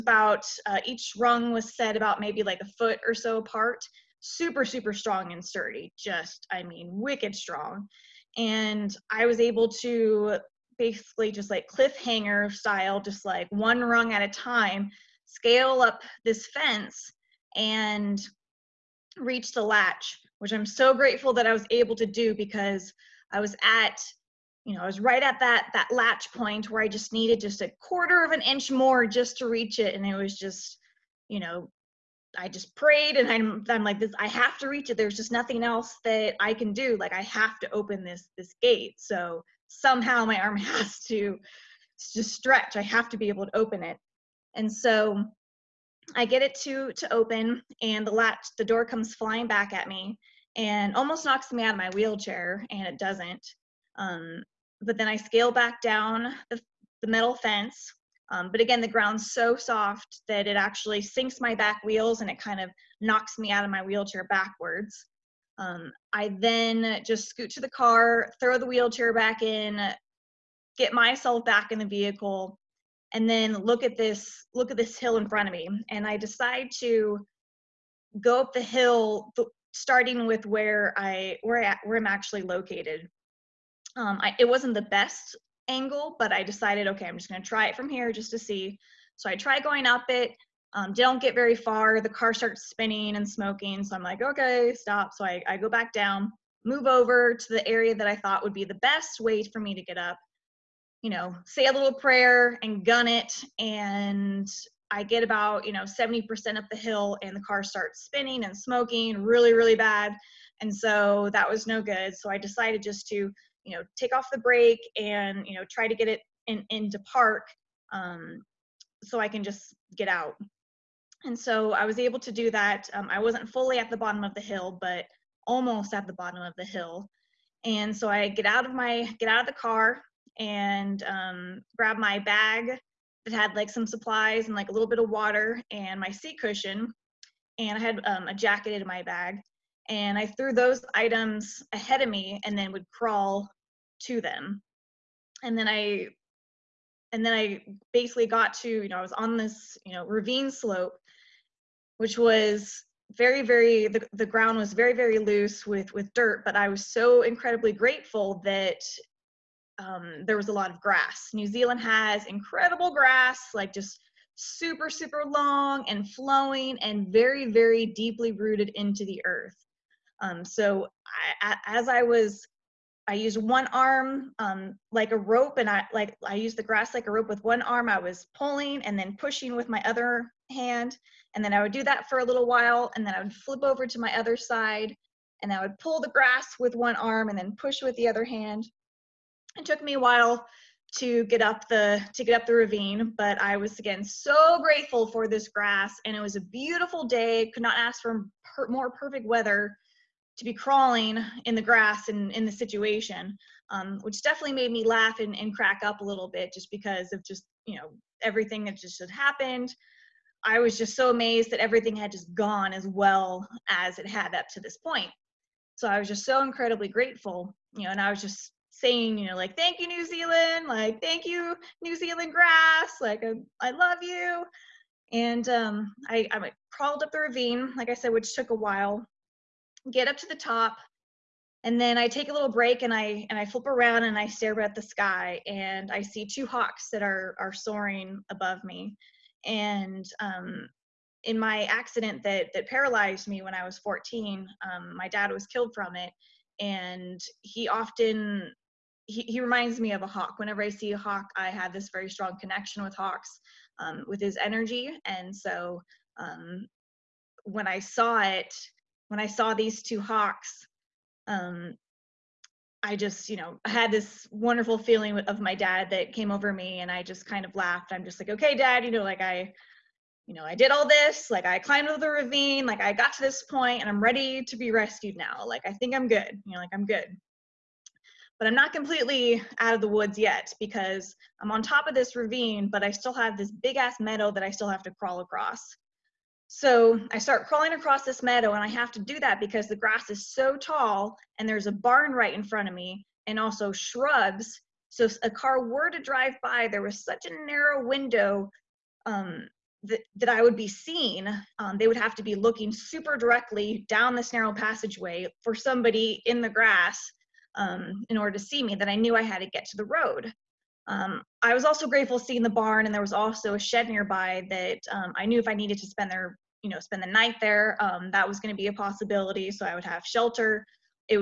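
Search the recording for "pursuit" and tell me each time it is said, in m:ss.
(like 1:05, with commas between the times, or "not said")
not said.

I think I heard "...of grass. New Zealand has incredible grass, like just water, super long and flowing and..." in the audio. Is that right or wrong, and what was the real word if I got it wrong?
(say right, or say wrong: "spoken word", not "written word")
wrong: "super", not "water".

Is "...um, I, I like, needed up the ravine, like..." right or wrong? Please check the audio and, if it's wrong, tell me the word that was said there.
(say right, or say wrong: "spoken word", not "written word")
wrong: "crawled", not "needed".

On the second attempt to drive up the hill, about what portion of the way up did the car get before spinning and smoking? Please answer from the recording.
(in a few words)
70%.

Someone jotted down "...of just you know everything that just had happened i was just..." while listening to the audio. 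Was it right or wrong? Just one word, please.
right.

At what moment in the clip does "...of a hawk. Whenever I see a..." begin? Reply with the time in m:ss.
4:09.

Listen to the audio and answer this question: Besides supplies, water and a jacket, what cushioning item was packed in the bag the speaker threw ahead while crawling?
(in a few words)
seat cushion.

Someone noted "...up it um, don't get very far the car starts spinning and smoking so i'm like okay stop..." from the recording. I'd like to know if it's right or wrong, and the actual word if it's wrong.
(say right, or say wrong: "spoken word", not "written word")
right.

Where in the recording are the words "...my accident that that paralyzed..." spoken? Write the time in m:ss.
4:01.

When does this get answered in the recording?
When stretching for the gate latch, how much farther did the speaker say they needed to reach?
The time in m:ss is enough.
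0:27.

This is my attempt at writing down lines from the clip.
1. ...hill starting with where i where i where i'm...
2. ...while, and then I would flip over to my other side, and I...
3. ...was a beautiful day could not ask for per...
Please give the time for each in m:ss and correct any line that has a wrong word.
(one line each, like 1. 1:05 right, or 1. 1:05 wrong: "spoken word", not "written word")
1. 1:18 right
2. 3:02 right
3. 3:16 right.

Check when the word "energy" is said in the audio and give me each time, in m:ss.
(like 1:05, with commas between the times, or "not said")
4:14.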